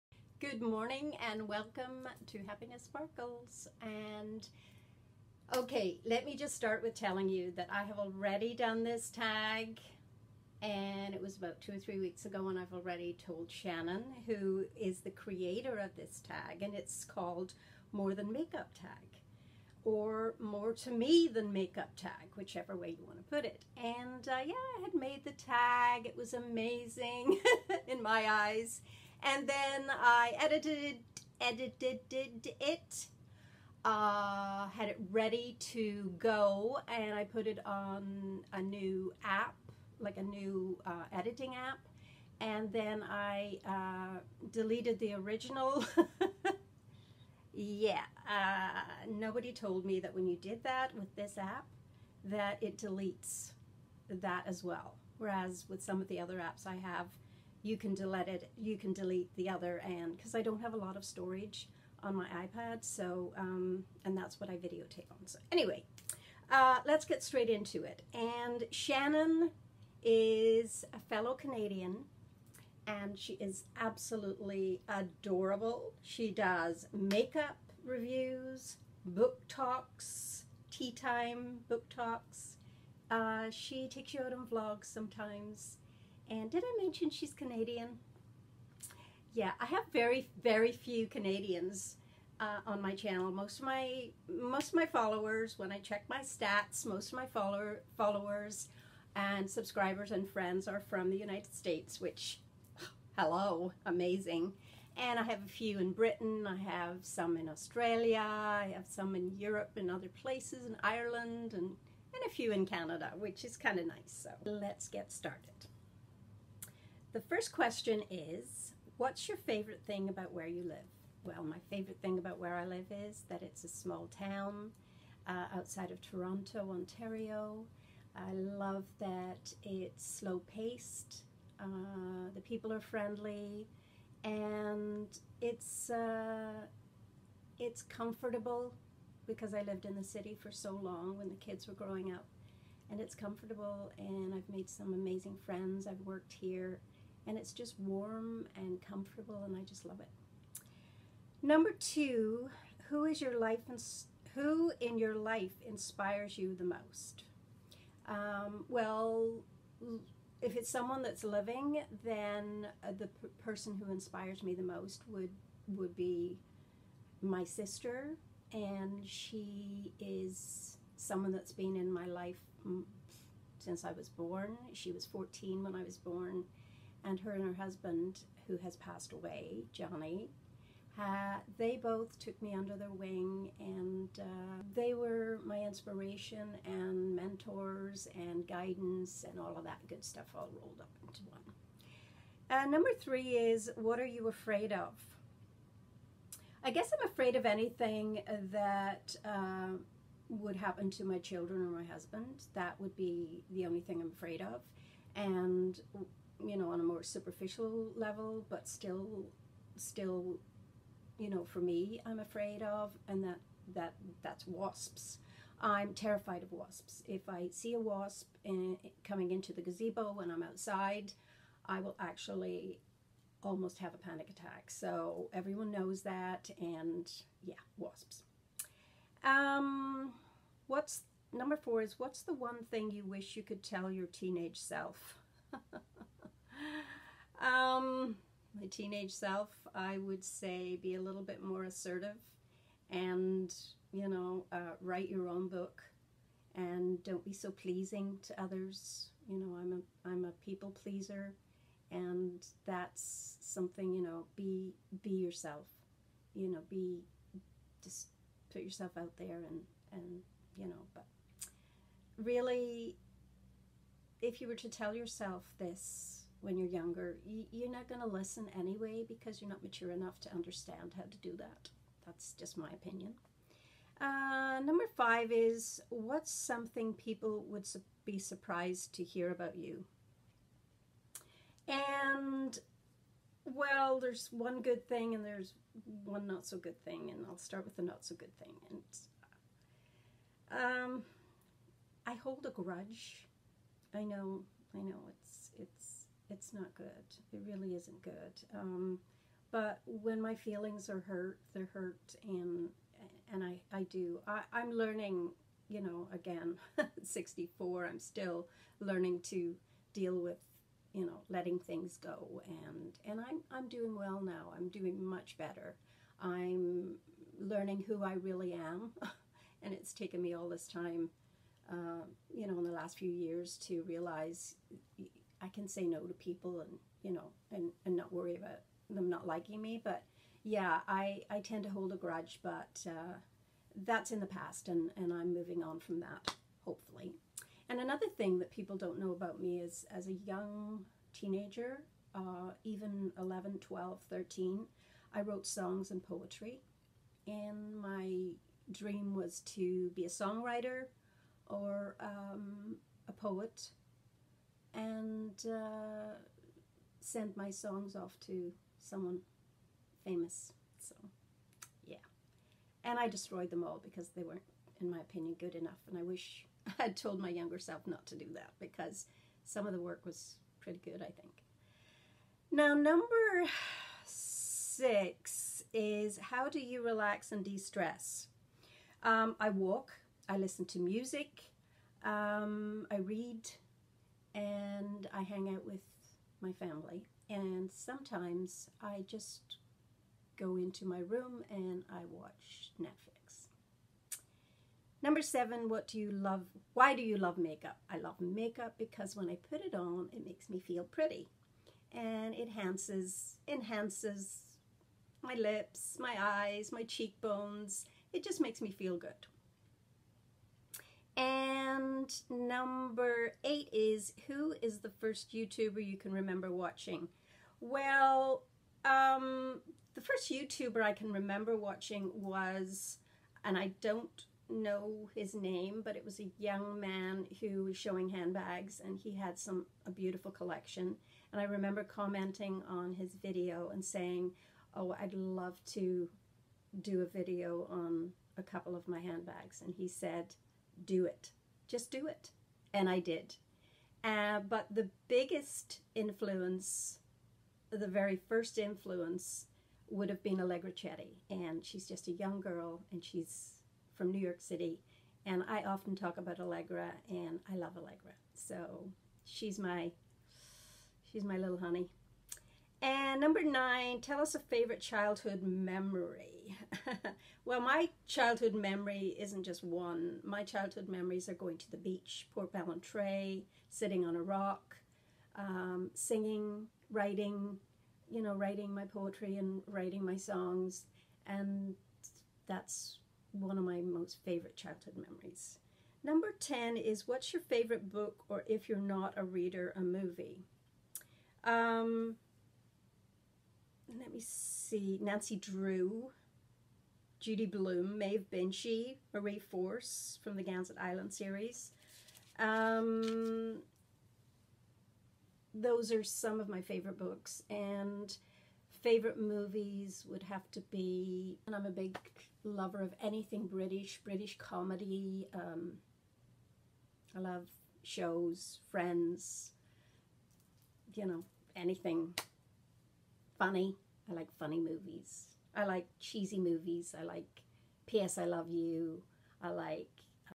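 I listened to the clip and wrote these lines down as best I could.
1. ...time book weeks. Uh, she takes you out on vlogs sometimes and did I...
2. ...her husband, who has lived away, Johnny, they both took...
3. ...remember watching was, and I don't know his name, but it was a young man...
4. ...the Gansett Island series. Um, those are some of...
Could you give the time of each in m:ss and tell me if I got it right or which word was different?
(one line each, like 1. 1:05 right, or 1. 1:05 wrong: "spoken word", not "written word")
1. 1:20 wrong: "talks", not "weeks"
2. 2:57 wrong: "passed", not "lived"
3. 7:01 right
4. 8:20 right.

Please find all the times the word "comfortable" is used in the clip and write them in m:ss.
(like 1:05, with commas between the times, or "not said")
2:17, 2:23, 2:28.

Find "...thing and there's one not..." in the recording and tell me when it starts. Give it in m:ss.
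4:44.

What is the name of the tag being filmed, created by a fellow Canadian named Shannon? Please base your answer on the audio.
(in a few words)
More Than Makeup Tag.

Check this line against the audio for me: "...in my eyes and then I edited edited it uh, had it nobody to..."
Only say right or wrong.
wrong.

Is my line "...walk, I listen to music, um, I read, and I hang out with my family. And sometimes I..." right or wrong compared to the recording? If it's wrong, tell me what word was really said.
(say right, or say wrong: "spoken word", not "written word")
right.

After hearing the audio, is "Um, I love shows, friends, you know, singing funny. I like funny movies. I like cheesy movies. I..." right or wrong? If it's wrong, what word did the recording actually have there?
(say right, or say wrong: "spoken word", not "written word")
wrong: "anything", not "singing".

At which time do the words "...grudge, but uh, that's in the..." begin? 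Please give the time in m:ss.
5:31.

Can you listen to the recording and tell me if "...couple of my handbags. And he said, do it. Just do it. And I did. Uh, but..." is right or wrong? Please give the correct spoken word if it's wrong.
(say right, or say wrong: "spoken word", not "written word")
right.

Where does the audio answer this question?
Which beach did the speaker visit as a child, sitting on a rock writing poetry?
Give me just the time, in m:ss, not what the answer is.
7:52.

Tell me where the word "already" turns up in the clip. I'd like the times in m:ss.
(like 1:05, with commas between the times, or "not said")
0:07, 0:12.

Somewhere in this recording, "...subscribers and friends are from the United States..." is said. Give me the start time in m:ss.
1:39.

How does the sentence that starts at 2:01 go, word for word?
Well, my favorite thing about where I live is that it's a small town uh, outside of Toronto, Ontario.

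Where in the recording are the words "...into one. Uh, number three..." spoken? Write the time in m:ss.
3:11.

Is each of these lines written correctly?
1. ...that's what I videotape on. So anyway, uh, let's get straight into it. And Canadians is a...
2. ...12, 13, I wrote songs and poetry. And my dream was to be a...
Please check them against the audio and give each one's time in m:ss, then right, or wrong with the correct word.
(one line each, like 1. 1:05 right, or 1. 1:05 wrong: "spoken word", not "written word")
1. 1:04 wrong: "Shannon", not "Canadians"
2. 5:43 right.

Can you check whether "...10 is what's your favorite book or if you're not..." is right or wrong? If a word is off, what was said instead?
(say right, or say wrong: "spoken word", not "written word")
right.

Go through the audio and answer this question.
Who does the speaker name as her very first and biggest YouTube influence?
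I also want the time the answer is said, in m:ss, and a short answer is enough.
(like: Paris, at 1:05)
Allegra Chetty, at 7:30.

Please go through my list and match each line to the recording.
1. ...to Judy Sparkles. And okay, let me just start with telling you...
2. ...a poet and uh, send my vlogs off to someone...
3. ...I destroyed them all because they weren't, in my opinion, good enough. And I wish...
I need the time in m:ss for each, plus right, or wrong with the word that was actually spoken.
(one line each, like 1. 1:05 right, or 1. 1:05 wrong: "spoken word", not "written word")
1. 0:02 wrong: "Happiness", not "Judy"
2. 5:53 wrong: "songs", not "vlogs"
3. 6:02 right.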